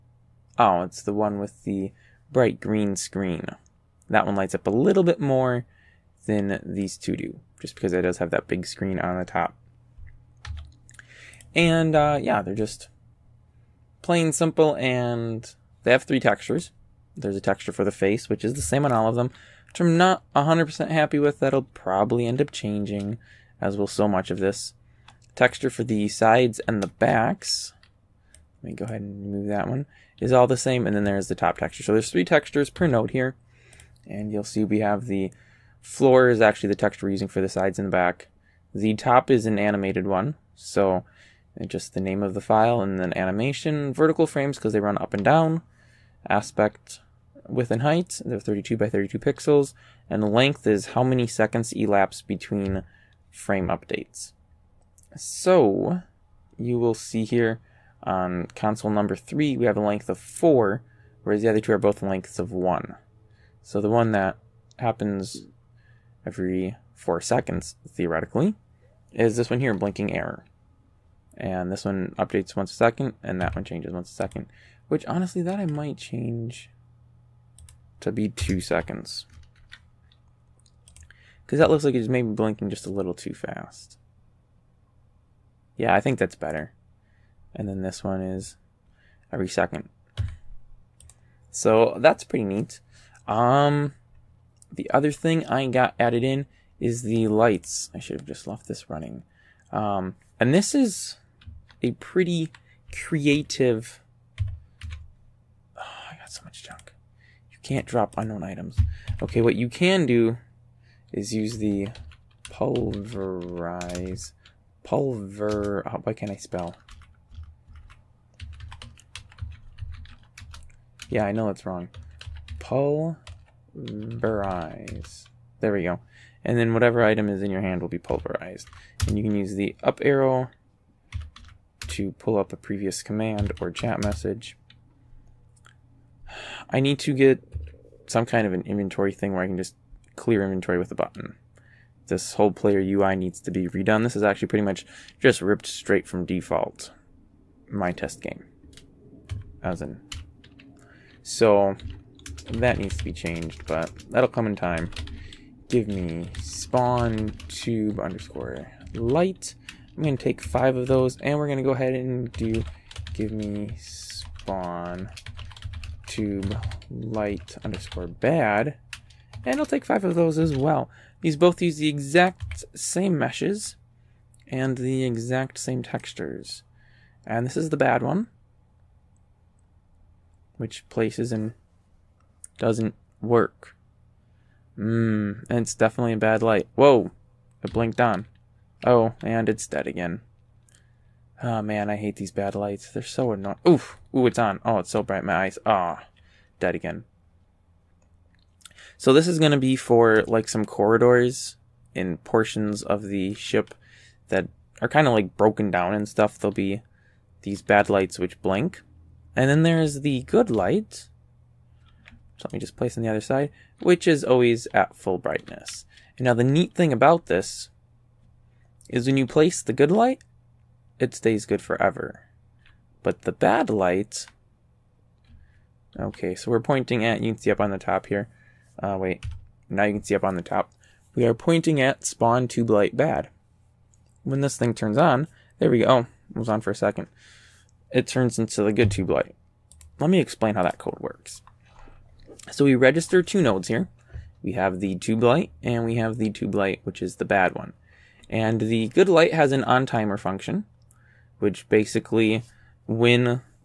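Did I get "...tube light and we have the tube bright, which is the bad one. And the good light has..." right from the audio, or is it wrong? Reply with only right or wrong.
wrong.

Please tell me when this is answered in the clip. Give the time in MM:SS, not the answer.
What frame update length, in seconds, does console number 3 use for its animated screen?
00:59.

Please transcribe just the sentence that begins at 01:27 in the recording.
And then this one is every second.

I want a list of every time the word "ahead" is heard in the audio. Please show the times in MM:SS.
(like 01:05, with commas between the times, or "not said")
00:28, 02:41.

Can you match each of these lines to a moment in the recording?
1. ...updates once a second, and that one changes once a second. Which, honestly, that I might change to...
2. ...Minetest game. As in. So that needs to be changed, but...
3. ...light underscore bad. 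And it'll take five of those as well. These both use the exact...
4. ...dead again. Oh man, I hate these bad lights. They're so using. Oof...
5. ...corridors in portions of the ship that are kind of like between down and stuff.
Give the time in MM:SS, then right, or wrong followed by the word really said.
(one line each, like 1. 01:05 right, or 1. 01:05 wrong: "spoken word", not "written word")
1. 01:12 right
2. 02:27 right
3. 02:46 right
4. 03:09 wrong: "annoying", not "using"
5. 03:20 wrong: "broken", not "between".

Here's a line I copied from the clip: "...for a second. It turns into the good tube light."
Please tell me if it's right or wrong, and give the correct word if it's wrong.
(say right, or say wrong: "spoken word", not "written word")
right.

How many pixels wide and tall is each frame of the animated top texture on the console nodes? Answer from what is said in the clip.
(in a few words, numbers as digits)
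32 by 32.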